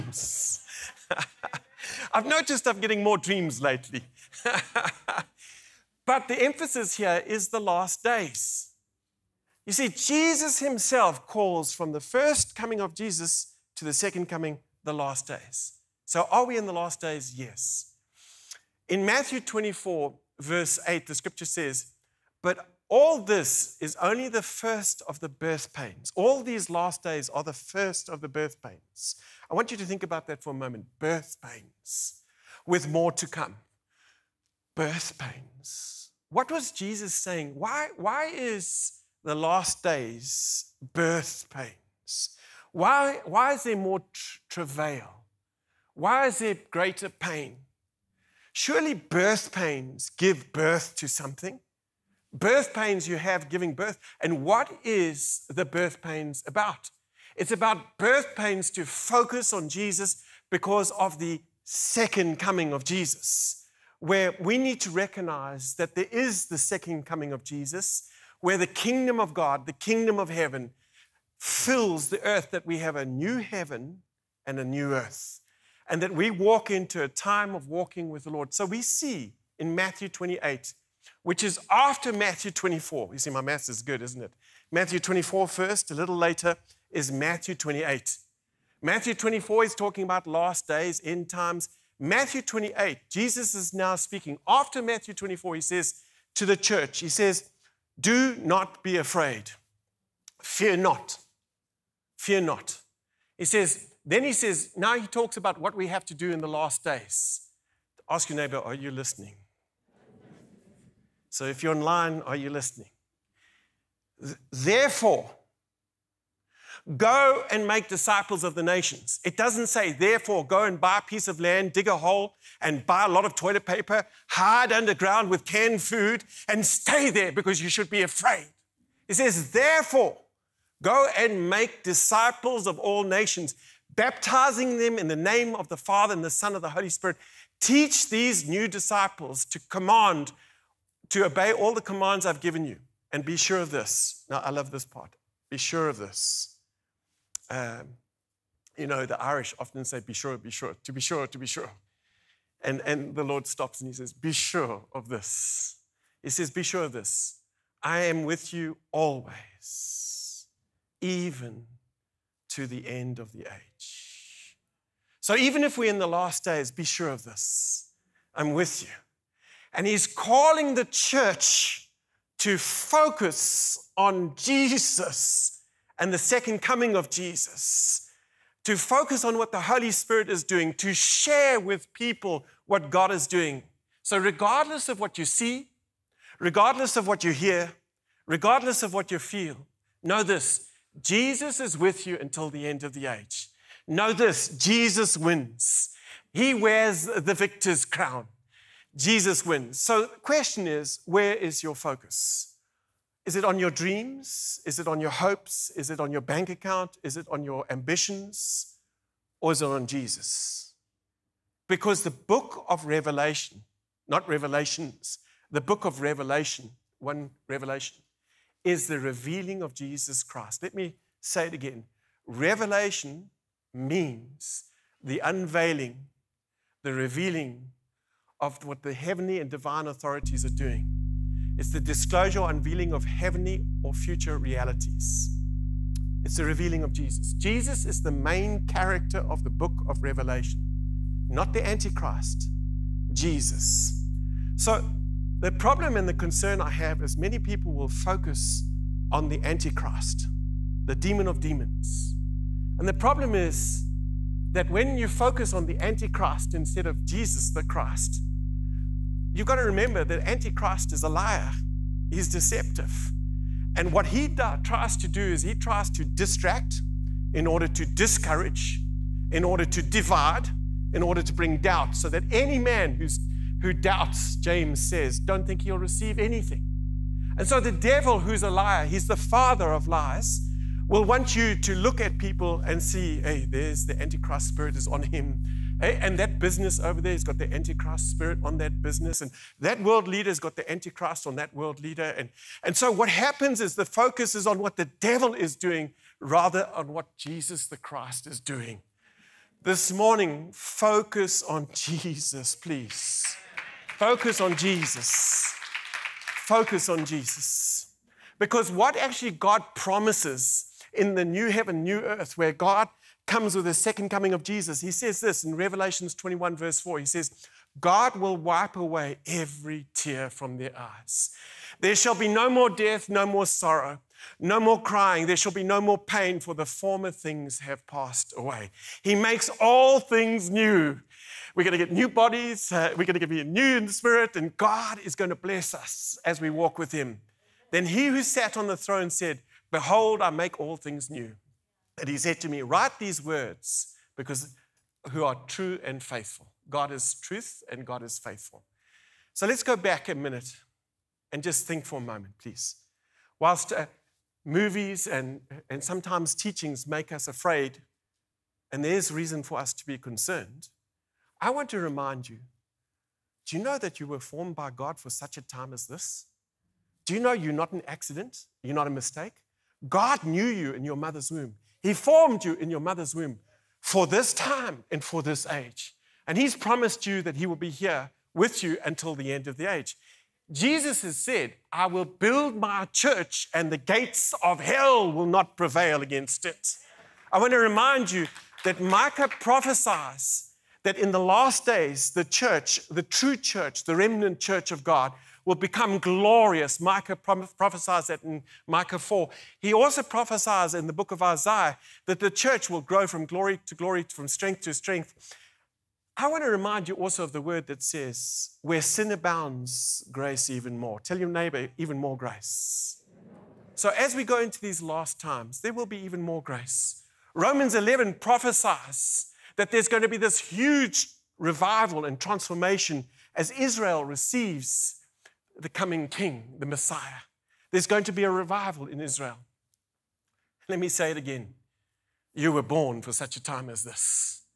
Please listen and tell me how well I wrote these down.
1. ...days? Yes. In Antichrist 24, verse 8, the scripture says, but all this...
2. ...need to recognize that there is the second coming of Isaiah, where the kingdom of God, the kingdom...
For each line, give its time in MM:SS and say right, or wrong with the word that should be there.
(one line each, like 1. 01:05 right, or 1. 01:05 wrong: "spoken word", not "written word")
1. 00:16 wrong: "Matthew", not "Antichrist"
2. 01:04 wrong: "Jesus", not "Isaiah".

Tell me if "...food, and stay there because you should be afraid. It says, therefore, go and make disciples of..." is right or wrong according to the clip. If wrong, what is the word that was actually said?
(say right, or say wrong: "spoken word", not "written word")
right.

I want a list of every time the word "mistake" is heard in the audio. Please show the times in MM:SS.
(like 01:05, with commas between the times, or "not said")
06:08.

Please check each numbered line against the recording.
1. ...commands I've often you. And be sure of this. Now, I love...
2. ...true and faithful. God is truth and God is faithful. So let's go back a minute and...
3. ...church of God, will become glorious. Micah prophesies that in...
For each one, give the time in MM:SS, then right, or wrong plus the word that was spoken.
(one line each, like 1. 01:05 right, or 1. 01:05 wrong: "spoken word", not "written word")
1. 02:21 wrong: "given", not "often"
2. 05:45 right
3. 06:34 right.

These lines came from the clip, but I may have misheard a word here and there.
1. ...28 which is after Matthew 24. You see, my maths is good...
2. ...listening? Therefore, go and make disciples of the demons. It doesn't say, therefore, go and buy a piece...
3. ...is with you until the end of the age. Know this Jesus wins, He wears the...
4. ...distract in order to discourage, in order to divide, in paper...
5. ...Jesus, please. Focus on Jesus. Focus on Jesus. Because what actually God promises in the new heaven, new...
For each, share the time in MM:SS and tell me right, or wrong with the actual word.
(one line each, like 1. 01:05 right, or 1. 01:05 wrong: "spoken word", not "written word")
1. 01:20 right
2. 01:52 wrong: "nations", not "demons"
3. 03:11 right
4. 04:26 wrong: "order", not "paper"
5. 05:01 right.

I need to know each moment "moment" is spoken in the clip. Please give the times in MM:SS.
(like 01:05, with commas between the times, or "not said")
00:30, 05:52.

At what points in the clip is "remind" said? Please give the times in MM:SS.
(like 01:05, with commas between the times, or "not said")
06:01, 06:27, 06:46.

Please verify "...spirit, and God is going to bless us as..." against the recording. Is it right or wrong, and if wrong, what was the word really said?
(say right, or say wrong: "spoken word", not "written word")
right.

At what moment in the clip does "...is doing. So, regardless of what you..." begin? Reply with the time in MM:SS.
03:03.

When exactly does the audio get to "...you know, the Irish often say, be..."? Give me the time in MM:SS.
02:28.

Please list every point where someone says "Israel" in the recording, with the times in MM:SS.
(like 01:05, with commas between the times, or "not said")
07:03, 07:08.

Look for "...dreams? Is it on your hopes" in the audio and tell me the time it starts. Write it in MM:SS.
03:23.